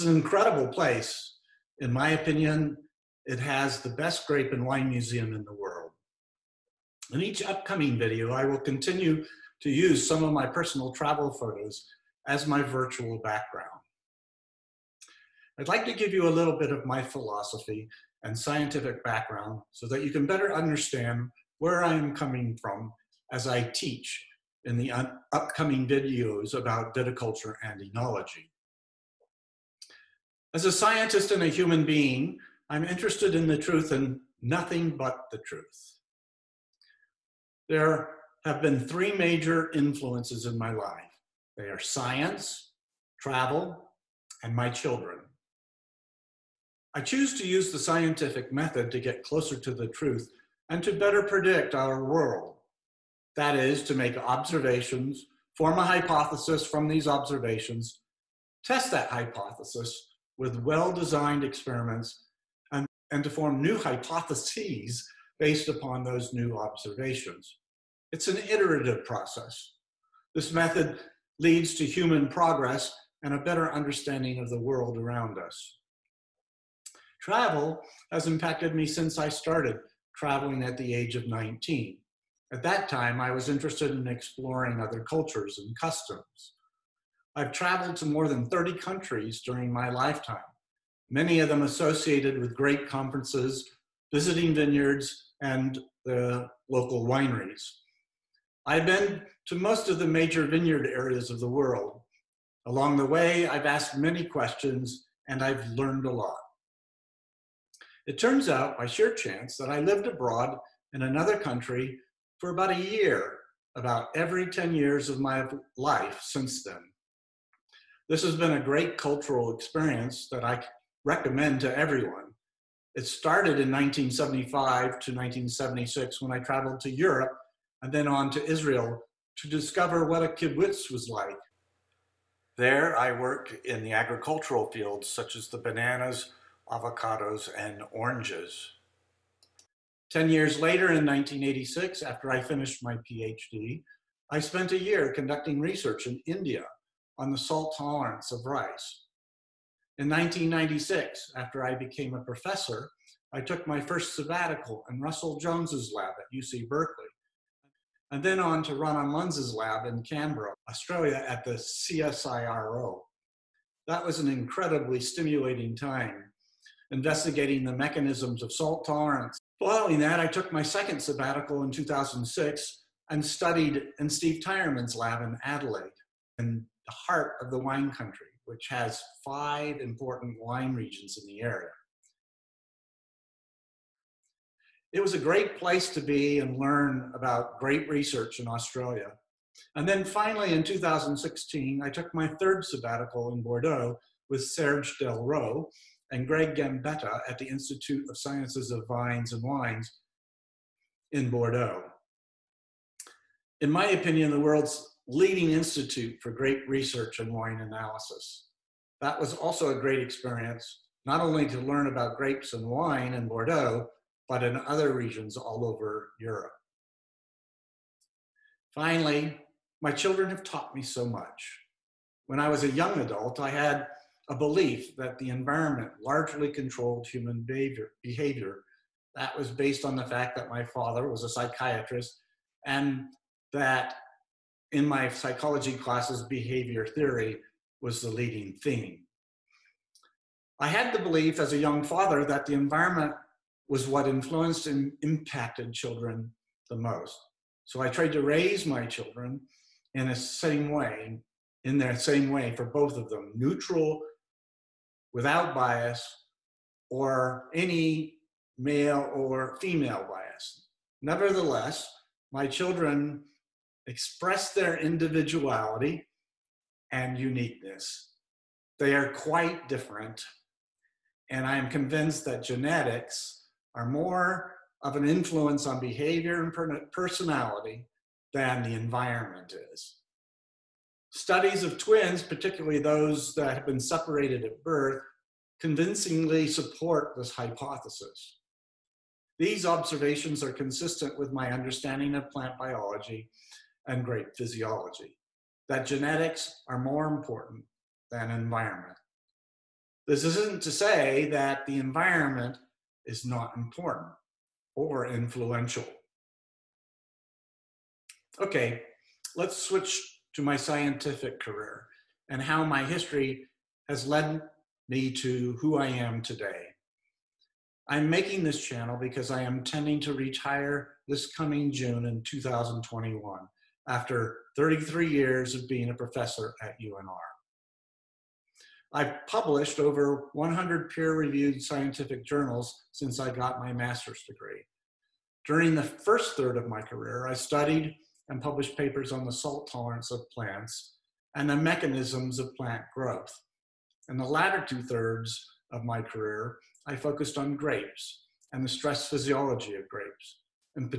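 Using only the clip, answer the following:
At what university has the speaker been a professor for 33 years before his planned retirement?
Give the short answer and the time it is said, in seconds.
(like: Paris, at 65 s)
UNR, at 326 s.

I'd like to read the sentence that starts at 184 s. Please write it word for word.
It was a great place to be and learn about great research in Australia.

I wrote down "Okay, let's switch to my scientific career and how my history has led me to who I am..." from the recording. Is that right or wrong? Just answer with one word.
right.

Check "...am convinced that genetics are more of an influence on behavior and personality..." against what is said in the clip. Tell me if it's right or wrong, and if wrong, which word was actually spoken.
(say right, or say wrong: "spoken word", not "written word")
right.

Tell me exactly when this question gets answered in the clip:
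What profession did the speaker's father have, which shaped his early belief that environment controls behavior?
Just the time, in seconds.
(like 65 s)
231 s.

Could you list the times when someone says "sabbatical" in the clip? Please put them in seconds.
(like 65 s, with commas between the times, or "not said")
154 s, 171 s, 192 s.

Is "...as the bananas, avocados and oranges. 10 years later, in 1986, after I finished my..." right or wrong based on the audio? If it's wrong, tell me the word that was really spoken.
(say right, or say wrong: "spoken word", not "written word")
right.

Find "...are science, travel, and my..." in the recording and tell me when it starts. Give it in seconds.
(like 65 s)
41 s.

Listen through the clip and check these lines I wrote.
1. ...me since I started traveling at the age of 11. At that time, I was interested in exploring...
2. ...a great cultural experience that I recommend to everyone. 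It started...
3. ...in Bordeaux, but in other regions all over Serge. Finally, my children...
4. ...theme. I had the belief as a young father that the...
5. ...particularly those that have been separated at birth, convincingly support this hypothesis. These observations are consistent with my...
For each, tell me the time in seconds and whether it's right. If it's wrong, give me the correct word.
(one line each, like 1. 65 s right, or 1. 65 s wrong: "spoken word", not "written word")
1. 78 s wrong: "19", not "11"
2. 118 s right
3. 213 s wrong: "Europe", not "Serge"
4. 238 s right
5. 282 s right.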